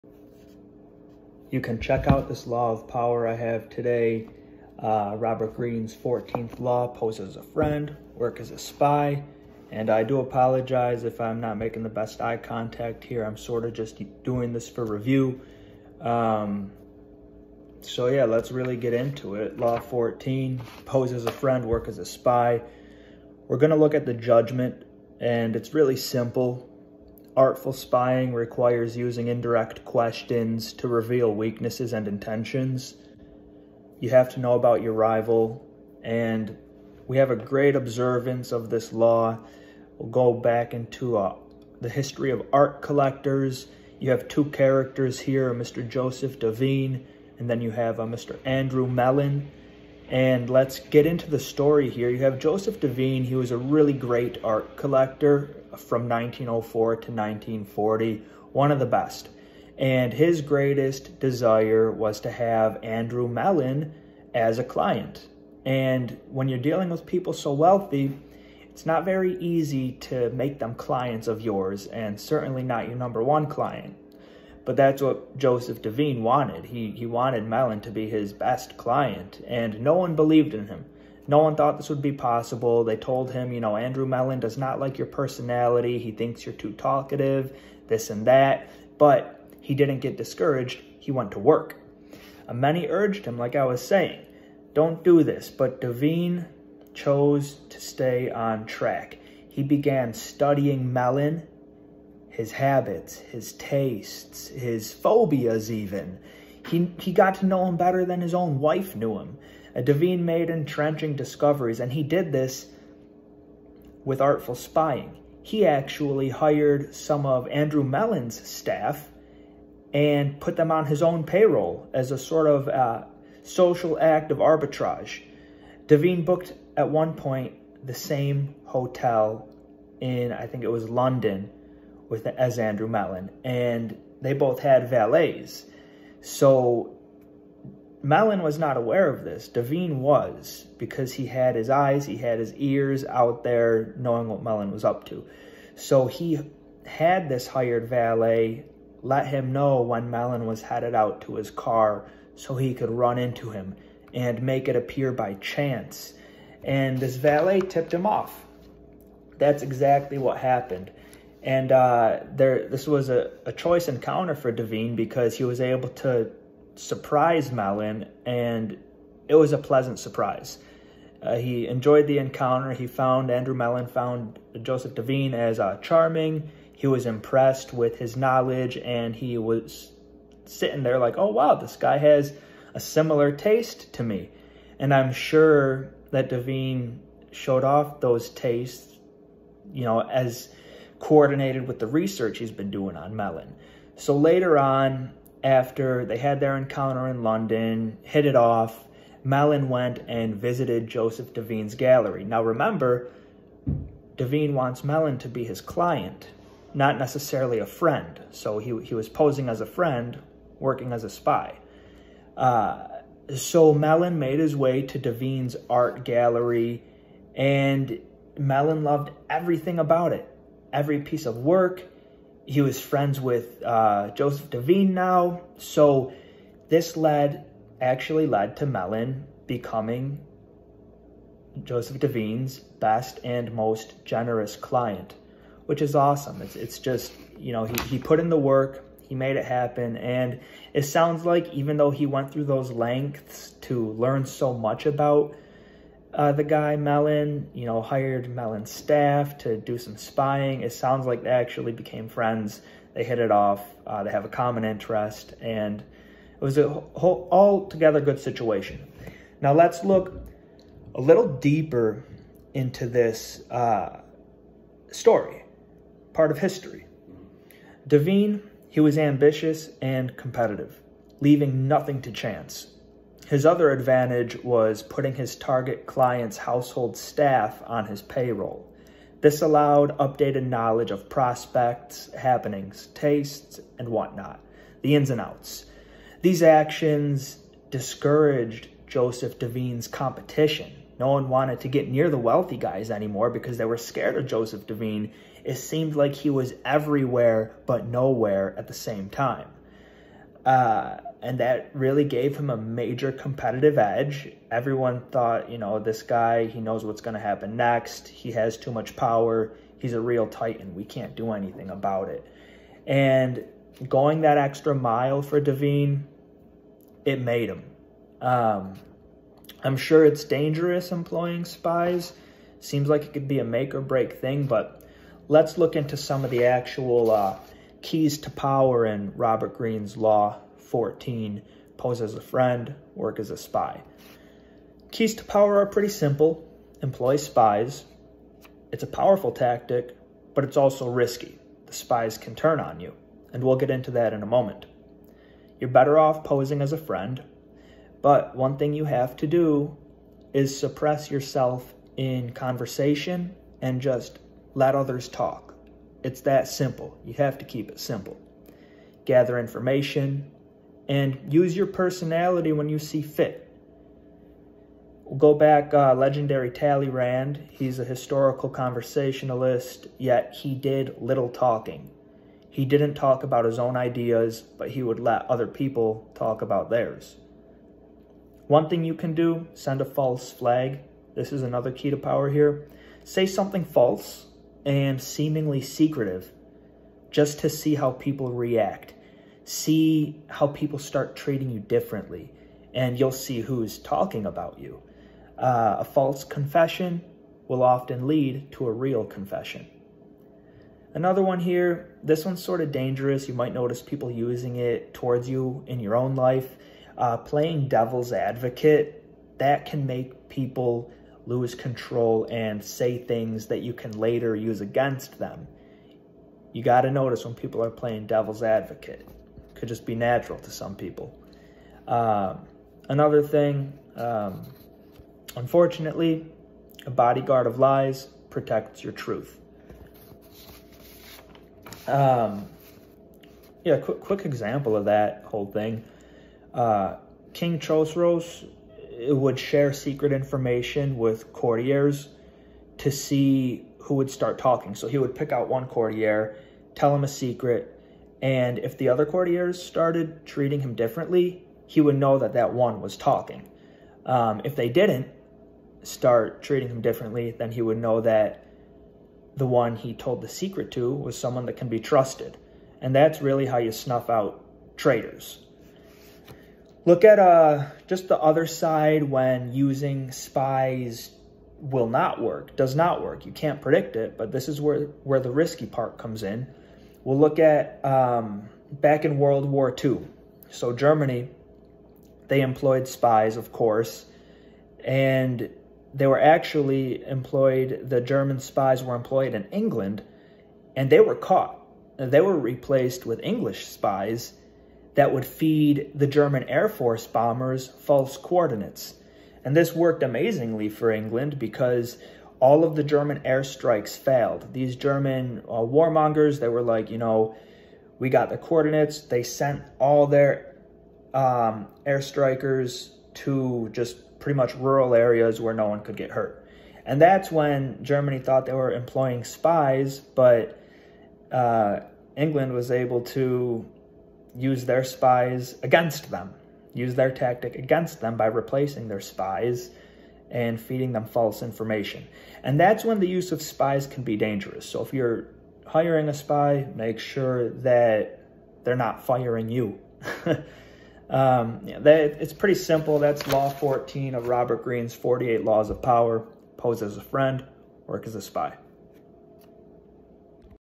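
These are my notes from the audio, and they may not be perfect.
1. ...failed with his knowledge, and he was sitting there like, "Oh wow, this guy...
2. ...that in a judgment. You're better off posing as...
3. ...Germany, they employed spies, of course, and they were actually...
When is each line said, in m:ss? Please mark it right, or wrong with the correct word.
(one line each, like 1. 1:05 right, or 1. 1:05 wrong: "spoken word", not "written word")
1. 2:57 wrong: "impressed", not "failed"
2. 5:43 wrong: "moment", not "judgment"
3. 8:00 right.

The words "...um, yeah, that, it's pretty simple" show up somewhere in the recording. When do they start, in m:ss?
9:01.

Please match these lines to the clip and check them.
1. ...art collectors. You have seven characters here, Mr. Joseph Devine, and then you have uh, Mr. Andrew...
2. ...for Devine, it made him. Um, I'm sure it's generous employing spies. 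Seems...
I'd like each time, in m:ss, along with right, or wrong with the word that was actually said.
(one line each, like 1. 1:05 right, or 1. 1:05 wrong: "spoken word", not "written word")
1. 0:42 wrong: "two", not "seven"
2. 5:15 wrong: "dangerous", not "generous".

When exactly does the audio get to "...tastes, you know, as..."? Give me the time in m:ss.
3:08.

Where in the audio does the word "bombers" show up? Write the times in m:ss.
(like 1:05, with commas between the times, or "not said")
8:17.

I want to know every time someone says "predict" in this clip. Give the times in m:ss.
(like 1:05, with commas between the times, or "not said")
7:53.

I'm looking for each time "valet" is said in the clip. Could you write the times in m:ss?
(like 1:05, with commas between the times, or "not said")
2:14, 2:27, 2:37.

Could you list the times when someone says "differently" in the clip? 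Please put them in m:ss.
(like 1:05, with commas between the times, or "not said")
6:31, 7:30, 7:36.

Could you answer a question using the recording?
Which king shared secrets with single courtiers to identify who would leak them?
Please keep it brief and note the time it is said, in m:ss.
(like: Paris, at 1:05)
King Chosroes, at 7:17.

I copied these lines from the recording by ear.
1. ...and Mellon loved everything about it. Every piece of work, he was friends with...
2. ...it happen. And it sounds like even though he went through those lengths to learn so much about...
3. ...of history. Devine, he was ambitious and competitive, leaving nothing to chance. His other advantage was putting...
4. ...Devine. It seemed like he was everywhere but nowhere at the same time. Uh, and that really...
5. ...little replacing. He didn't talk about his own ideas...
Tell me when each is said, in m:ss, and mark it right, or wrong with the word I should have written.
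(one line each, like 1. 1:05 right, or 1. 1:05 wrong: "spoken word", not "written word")
1. 3:37 right
2. 3:59 right
3. 4:26 right
4. 4:54 right
5. 6:10 wrong: "talking", not "replacing".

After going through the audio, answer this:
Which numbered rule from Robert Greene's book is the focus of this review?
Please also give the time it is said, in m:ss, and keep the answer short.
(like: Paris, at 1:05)
14th law, at 0:05.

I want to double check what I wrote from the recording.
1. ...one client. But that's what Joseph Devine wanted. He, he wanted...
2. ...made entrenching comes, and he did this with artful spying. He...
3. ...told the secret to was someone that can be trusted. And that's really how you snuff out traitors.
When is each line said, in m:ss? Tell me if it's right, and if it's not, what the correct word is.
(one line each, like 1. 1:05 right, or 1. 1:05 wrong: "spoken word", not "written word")
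1. 1:13 right
2. 1:50 wrong: "discoveries", not "comes"
3. 7:39 right.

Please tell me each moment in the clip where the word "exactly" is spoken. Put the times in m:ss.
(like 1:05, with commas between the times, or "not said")
2:39.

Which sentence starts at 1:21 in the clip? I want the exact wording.
No one thought this would be possible.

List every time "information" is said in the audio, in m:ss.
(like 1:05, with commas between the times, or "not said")
5:59, 7:20, 8:51.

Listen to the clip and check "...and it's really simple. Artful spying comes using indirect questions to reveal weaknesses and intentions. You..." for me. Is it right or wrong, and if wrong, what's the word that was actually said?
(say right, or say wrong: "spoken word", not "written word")
wrong: "requires", not "comes".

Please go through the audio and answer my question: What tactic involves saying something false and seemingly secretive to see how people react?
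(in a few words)
false flag.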